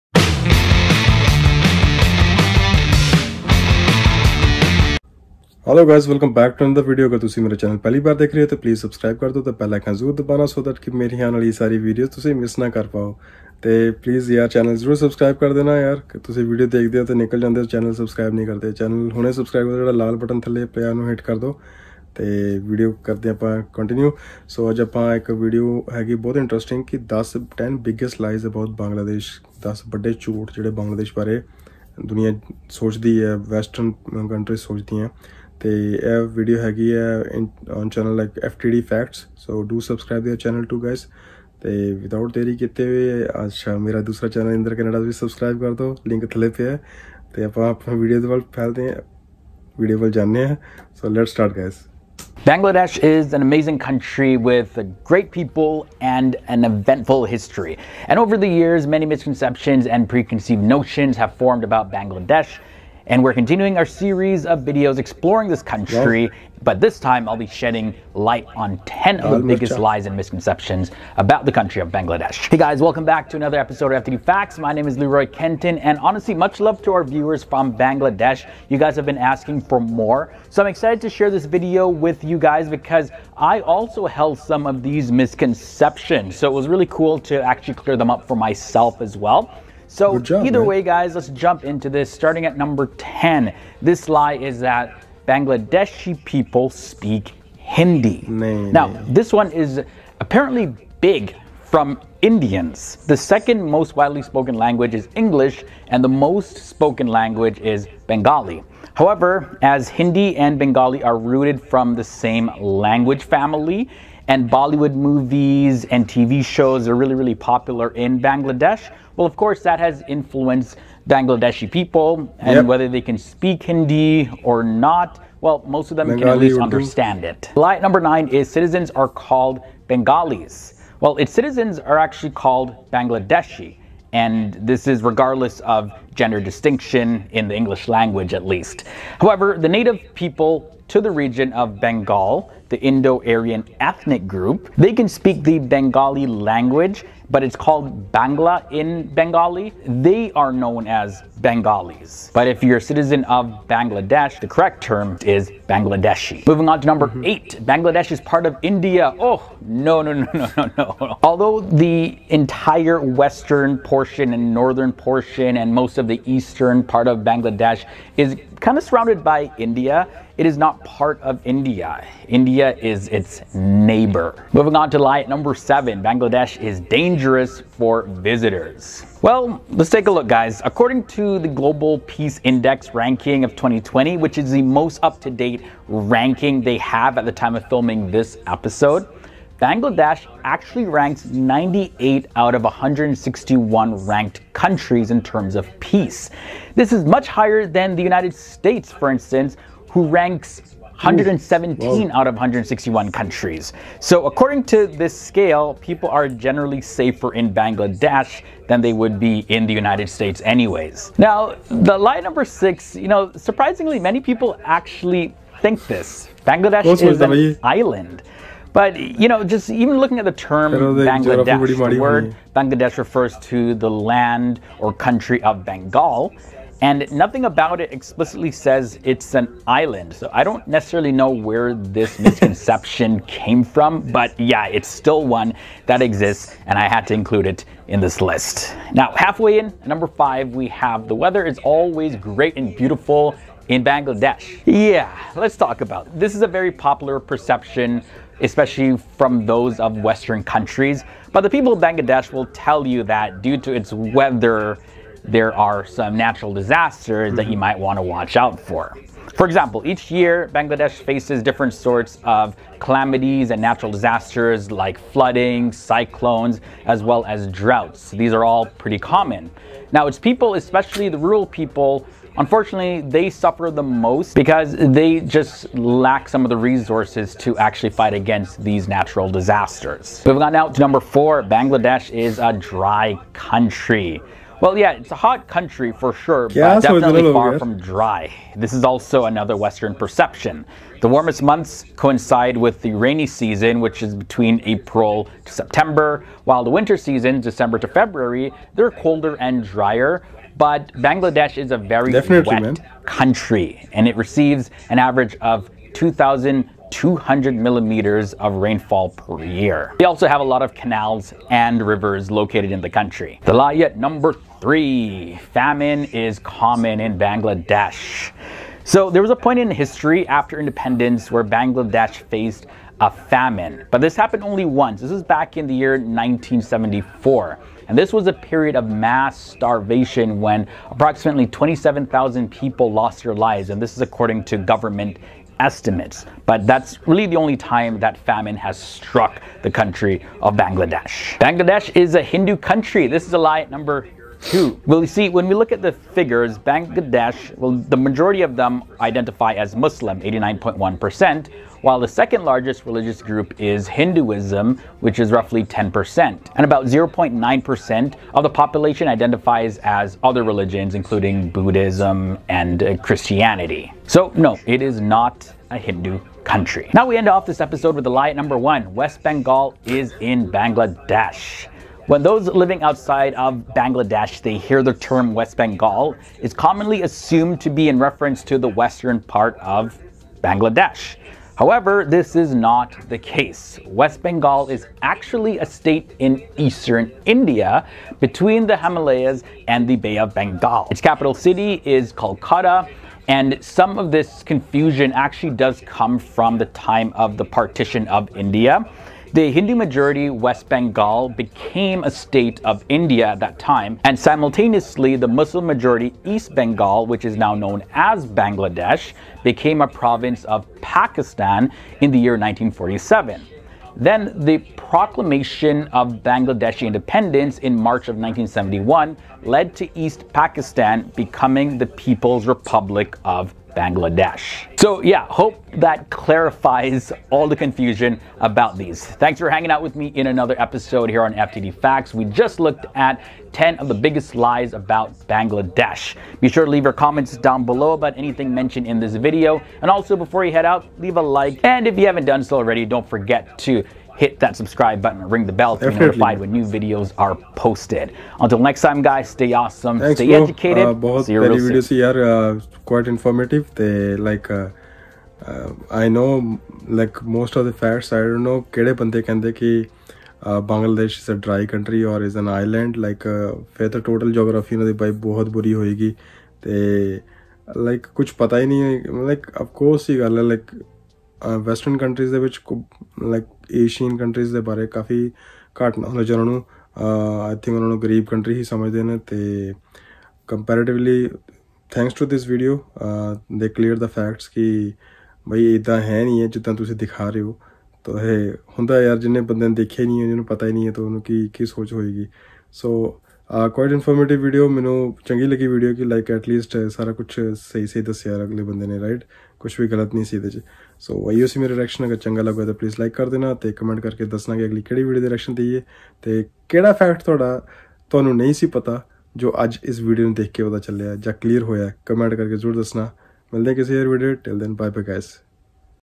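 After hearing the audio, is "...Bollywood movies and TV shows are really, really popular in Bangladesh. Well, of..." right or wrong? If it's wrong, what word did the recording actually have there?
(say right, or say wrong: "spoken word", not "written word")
right.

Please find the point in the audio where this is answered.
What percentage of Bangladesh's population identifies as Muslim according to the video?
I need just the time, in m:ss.
5:50.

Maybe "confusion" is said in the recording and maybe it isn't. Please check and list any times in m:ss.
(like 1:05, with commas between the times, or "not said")
6:34, 7:07.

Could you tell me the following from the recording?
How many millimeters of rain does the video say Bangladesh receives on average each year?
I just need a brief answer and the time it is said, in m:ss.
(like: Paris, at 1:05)
2,200, at 5:05.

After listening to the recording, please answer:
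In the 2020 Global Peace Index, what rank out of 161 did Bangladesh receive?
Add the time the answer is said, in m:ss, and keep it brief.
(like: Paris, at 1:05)
98, at 3:11.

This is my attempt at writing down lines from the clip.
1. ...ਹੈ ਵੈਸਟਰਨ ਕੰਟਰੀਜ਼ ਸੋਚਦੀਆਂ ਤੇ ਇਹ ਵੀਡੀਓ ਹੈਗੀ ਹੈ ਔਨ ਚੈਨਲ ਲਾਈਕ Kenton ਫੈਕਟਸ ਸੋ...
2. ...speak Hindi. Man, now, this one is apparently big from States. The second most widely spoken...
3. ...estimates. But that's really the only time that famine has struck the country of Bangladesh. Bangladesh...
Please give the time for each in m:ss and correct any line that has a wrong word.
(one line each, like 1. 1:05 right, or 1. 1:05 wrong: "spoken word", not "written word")
1. 0:33 wrong: "FTD", not "Kenton"
2. 1:36 wrong: "Indians", not "States"
3. 5:35 right.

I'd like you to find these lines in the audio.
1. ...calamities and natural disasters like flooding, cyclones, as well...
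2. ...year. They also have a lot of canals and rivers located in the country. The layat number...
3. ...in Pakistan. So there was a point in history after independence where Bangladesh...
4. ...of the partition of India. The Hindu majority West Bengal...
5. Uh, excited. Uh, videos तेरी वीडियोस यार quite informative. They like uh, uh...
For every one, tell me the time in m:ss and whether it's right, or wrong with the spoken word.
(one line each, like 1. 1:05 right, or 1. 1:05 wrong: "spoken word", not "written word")
1. 4:22 right
2. 5:09 right
3. 5:16 wrong: "Bangladesh", not "Pakistan"
4. 6:37 right
5. 7:30 wrong: "educated", not "excited".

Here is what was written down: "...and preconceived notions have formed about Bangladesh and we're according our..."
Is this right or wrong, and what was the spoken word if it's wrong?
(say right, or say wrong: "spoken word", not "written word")
wrong: "continuing", not "according".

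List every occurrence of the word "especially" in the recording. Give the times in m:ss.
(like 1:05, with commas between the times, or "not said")
4:08, 4:30.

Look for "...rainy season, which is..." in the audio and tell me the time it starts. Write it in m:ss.
4:52.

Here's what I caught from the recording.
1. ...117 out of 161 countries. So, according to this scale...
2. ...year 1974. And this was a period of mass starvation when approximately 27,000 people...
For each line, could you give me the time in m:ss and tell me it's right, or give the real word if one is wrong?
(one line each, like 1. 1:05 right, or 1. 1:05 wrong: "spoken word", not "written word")
1. 3:20 right
2. 5:25 right.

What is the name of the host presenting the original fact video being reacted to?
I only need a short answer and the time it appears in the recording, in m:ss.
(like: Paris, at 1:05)
Leroy Kenton, at 1:14.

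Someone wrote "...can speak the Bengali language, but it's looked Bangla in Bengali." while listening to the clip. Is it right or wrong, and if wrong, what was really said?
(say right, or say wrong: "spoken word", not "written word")
wrong: "called", not "looked".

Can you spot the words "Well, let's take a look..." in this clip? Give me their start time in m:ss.
2:59.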